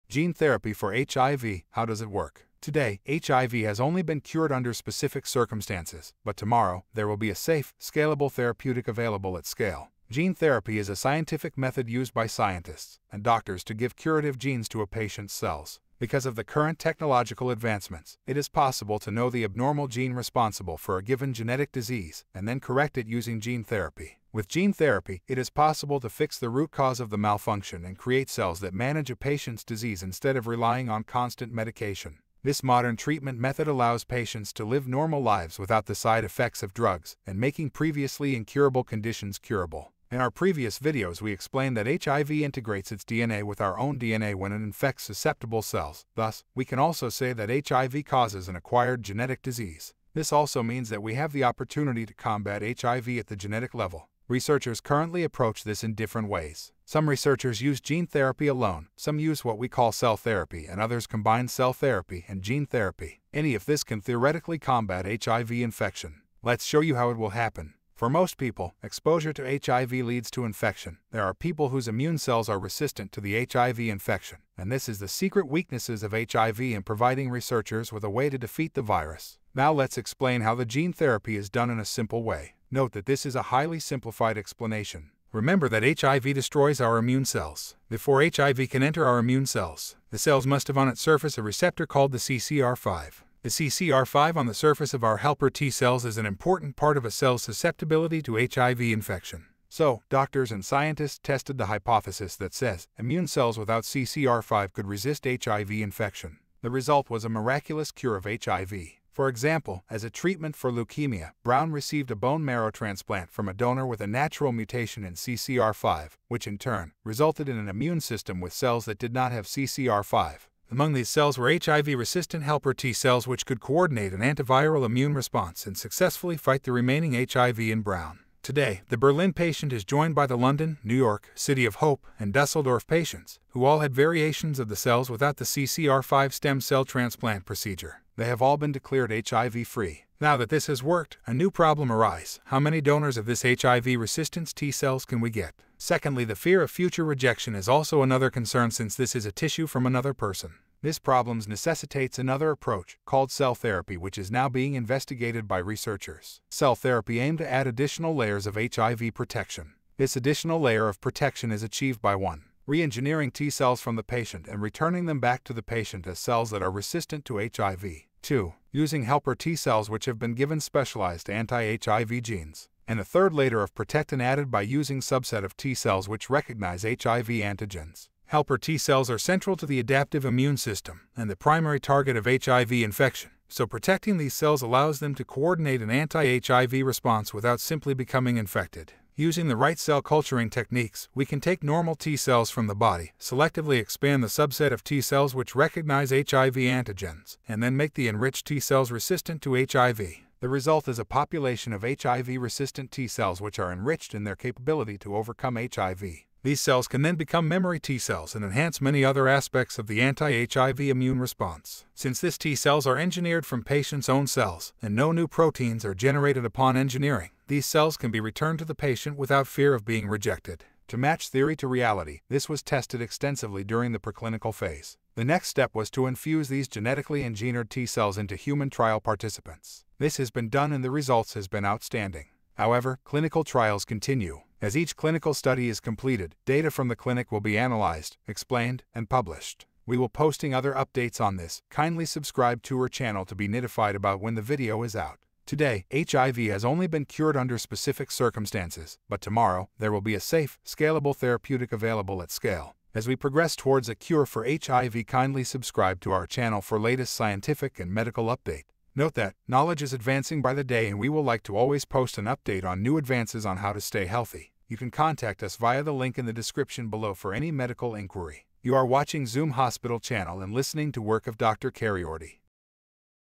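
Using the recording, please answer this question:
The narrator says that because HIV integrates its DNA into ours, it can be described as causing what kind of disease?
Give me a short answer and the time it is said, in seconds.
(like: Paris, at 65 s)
acquired genetic disease, at 48 s.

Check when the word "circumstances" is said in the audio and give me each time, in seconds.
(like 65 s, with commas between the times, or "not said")
5 s, 248 s.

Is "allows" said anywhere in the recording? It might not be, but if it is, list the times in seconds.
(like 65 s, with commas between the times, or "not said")
33 s, 184 s.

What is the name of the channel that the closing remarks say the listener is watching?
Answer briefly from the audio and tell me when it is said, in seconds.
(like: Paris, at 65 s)
Zoom Hospital, at 269 s.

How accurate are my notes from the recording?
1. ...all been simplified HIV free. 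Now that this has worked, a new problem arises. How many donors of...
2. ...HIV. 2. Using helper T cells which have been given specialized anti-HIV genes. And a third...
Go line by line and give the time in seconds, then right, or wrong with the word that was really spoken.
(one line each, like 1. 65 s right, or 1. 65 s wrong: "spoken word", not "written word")
1. 138 s wrong: "declared", not "simplified"
2. 167 s right.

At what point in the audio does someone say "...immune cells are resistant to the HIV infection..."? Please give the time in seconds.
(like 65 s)
71 s.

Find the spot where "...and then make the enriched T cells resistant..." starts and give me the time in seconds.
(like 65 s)
197 s.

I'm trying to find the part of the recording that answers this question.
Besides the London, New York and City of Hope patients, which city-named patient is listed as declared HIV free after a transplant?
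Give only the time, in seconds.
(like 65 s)
132 s.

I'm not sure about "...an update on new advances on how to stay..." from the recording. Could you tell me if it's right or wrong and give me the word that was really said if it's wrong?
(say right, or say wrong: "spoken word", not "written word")
right.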